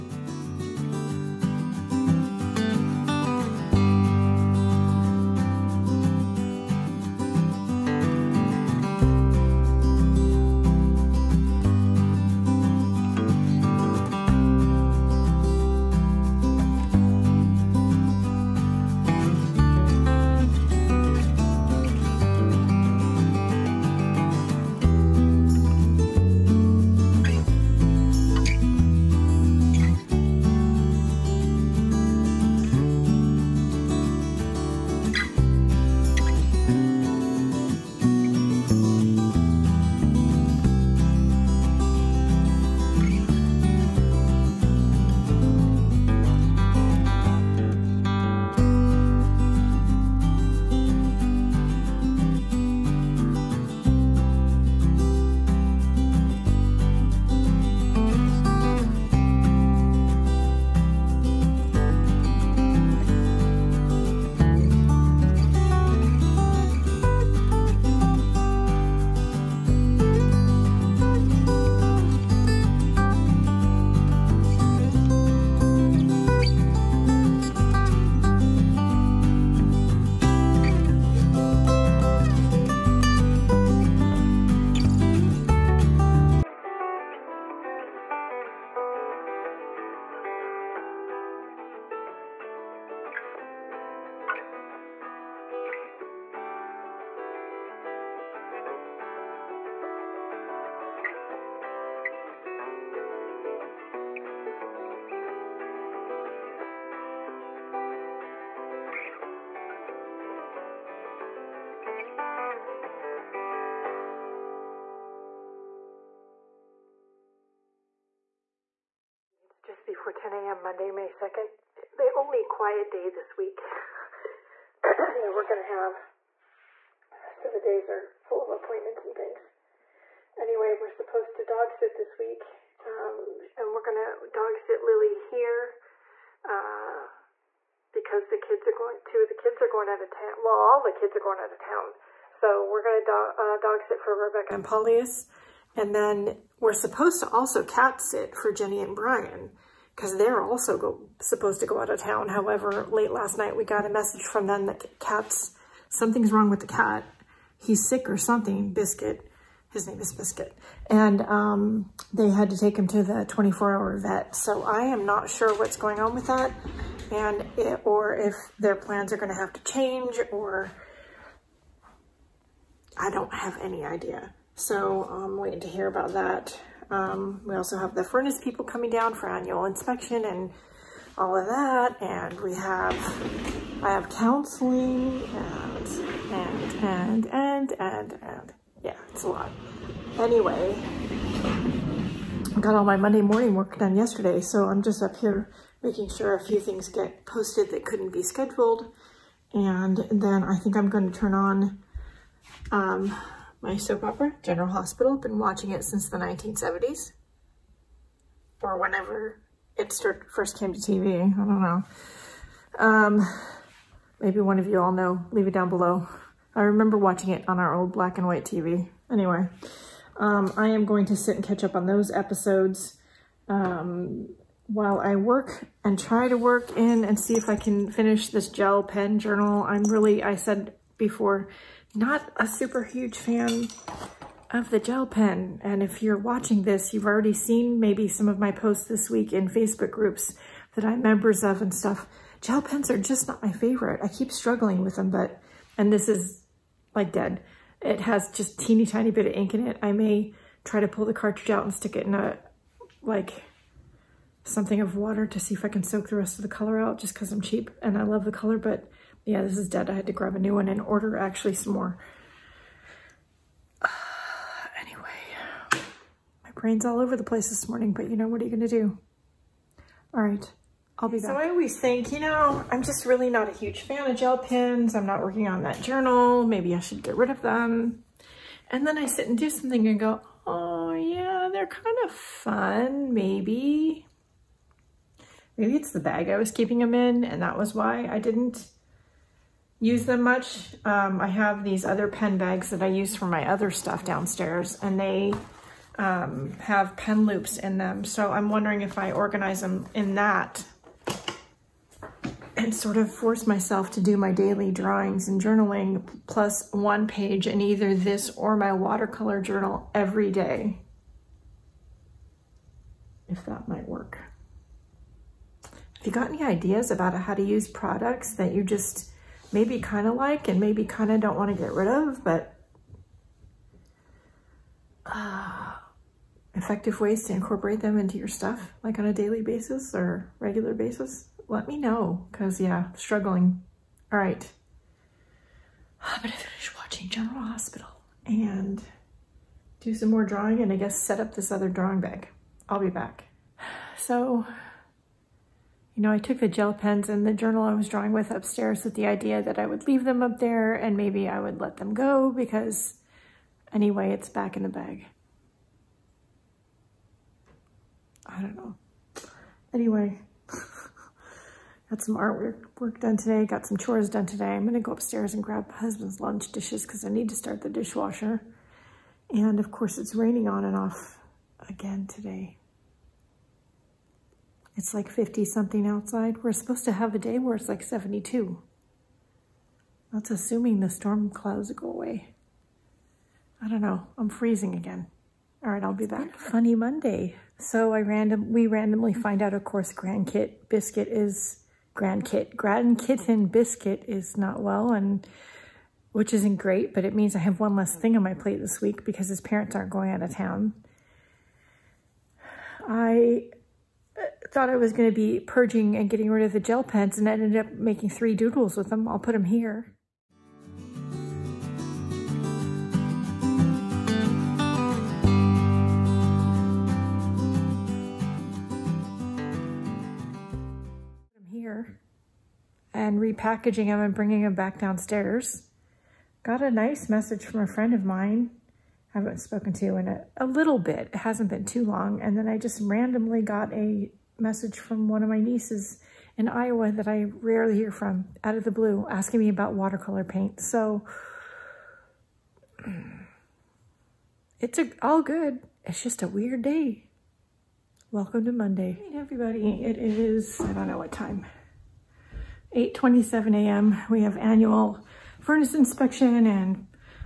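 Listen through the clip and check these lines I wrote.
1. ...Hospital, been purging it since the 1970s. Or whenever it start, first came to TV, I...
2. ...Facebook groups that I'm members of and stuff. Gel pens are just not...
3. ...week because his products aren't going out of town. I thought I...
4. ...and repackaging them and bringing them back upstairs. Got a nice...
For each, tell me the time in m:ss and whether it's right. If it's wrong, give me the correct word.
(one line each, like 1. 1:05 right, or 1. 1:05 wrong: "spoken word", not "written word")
1. 3:24 wrong: "watching", not "purging"
2. 3:59 right
3. 6:38 wrong: "parents", not "products"
4. 7:02 wrong: "downstairs", not "upstairs".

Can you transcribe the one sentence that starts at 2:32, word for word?
However, late last night, we got a message from them that cats, something's wrong with the cat.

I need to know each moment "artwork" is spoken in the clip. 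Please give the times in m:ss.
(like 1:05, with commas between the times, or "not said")
6:02.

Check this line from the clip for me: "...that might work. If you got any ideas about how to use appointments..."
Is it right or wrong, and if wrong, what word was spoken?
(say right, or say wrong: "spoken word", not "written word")
wrong: "products", not "appointments".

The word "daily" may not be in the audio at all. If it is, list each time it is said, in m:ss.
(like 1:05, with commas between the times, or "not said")
5:04, 5:29.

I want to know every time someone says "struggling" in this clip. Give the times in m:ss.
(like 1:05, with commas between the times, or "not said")
4:04, 5:32.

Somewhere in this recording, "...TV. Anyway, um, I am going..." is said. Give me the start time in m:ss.
3:38.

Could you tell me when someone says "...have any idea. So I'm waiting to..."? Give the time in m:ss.
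2:53.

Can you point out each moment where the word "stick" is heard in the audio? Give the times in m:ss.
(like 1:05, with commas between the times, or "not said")
4:11.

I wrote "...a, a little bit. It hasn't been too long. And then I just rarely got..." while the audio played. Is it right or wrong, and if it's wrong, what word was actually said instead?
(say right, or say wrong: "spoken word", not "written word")
wrong: "randomly", not "rarely".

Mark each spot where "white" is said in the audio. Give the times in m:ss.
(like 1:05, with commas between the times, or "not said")
3:38.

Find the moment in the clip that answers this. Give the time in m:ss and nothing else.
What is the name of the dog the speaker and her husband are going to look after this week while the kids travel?
2:14.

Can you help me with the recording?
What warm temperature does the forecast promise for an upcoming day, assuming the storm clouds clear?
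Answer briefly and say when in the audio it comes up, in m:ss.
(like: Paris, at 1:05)
72, at 6:17.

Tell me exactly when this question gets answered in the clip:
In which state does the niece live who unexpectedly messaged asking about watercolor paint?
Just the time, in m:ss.
7:16.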